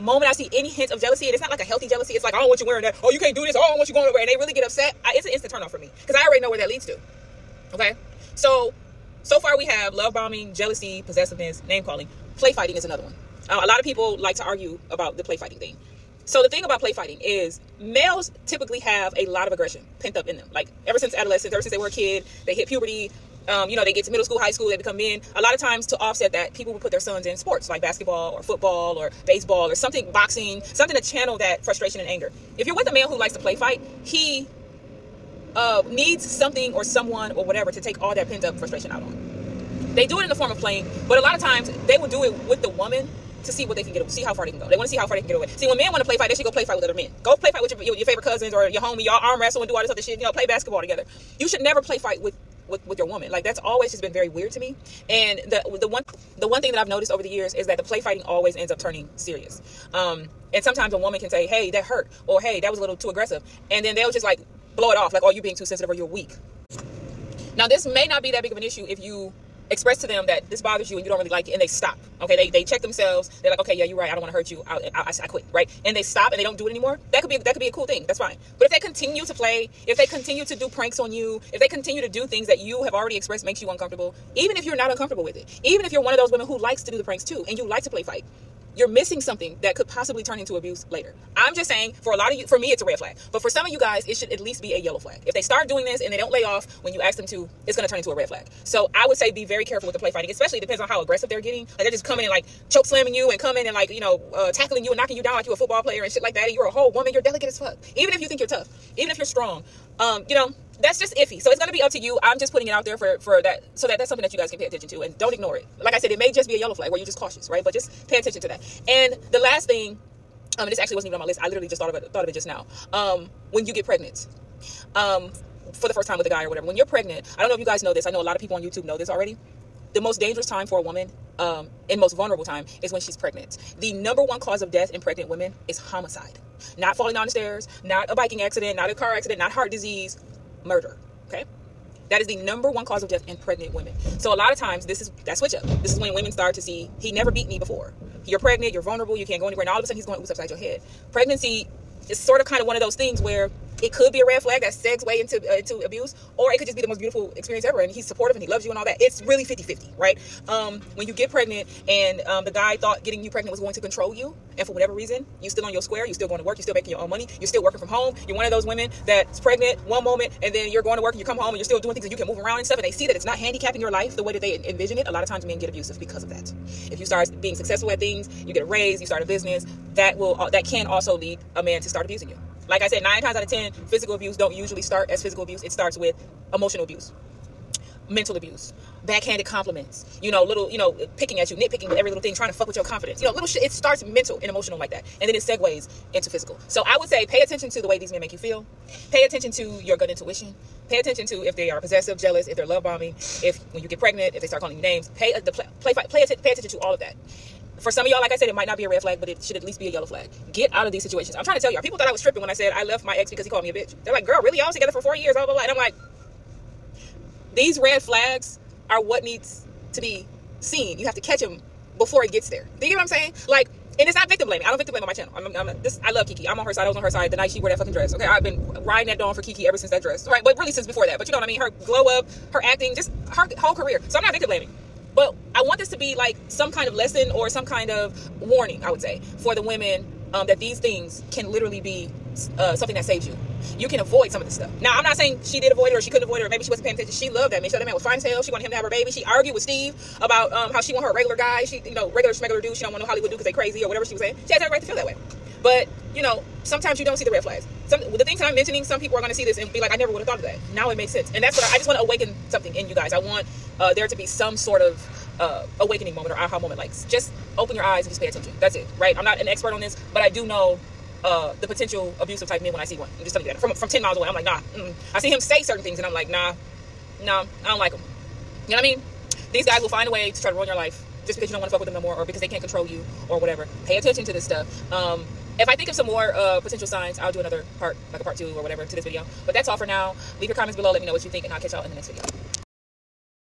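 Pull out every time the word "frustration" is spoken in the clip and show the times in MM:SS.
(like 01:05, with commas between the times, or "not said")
00:31, 00:38.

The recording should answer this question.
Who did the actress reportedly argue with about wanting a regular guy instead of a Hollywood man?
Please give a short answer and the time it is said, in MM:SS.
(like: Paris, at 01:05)
Steve, at 04:09.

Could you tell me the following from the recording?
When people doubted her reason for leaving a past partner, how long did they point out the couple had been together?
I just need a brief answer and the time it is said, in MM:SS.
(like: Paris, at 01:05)
4 years, at 03:35.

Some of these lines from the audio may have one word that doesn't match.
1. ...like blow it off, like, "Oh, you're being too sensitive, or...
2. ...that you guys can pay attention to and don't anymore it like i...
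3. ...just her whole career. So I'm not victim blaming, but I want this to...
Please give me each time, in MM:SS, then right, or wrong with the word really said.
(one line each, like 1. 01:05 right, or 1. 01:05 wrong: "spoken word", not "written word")
1. 01:04 right
2. 01:54 wrong: "ignore", not "anymore"
3. 03:52 right.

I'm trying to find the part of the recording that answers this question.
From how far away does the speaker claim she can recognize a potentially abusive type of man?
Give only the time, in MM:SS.
04:33.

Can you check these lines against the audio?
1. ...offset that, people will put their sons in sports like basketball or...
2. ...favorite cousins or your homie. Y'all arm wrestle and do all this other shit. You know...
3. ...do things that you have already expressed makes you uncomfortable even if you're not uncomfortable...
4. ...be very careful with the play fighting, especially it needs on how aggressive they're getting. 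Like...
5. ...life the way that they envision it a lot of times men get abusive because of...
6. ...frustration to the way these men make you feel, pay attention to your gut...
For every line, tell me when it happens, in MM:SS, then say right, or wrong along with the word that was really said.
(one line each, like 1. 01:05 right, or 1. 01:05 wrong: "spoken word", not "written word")
1. 00:25 right
2. 00:48 right
3. 01:22 right
4. 01:39 wrong: "depends", not "needs"
5. 02:53 right
6. 03:17 wrong: "attention", not "frustration".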